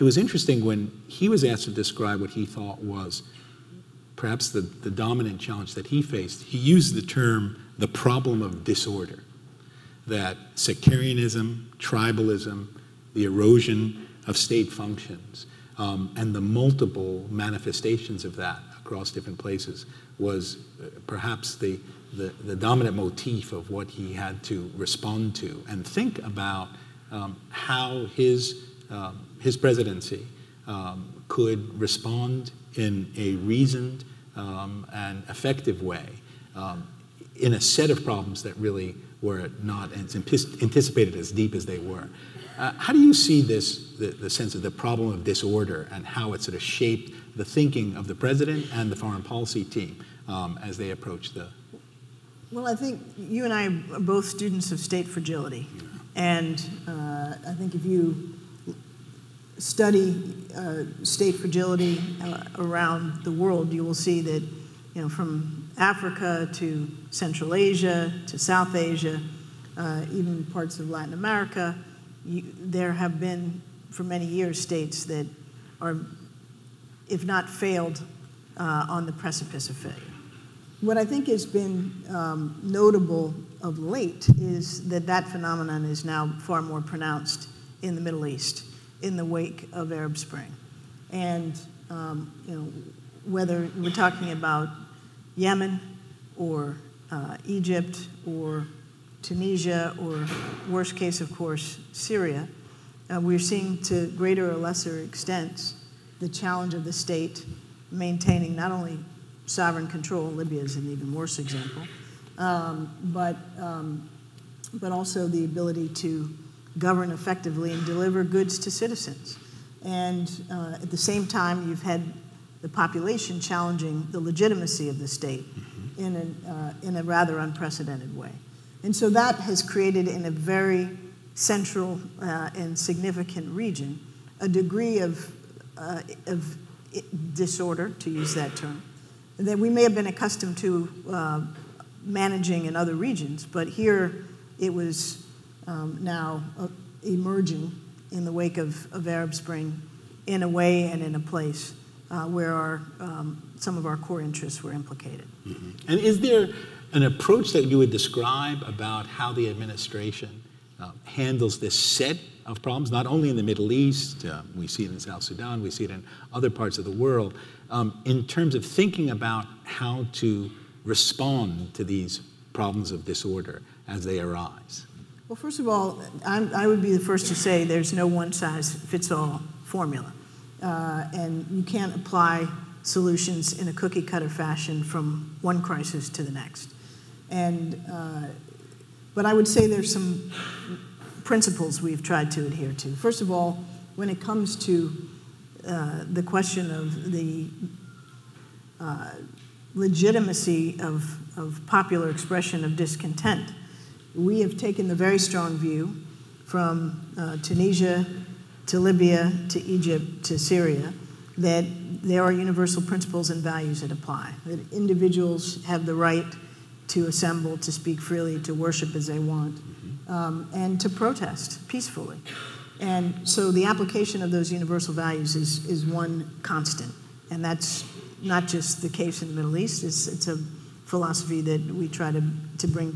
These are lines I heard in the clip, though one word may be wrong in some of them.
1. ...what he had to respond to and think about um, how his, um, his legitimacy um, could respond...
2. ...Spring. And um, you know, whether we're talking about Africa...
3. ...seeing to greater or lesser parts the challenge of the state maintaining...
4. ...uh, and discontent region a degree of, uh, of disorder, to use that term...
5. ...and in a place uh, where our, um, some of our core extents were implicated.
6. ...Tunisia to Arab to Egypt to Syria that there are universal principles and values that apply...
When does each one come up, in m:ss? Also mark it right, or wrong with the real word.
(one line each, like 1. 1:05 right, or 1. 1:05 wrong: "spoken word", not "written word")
1. 0:23 wrong: "presidency", not "legitimacy"
2. 1:30 wrong: "Yemen", not "Africa"
3. 1:43 wrong: "extents", not "parts"
4. 2:12 wrong: "significant", not "discontent"
5. 2:30 wrong: "interests", not "extents"
6. 3:27 wrong: "Libya", not "Arab".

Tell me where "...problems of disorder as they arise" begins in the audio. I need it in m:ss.
2:52.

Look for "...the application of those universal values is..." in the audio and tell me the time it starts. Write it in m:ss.
3:43.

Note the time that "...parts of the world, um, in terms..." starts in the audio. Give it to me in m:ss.
2:46.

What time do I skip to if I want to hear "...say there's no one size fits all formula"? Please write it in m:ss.
2:57.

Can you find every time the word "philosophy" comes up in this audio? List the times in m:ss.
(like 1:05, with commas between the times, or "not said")
3:50.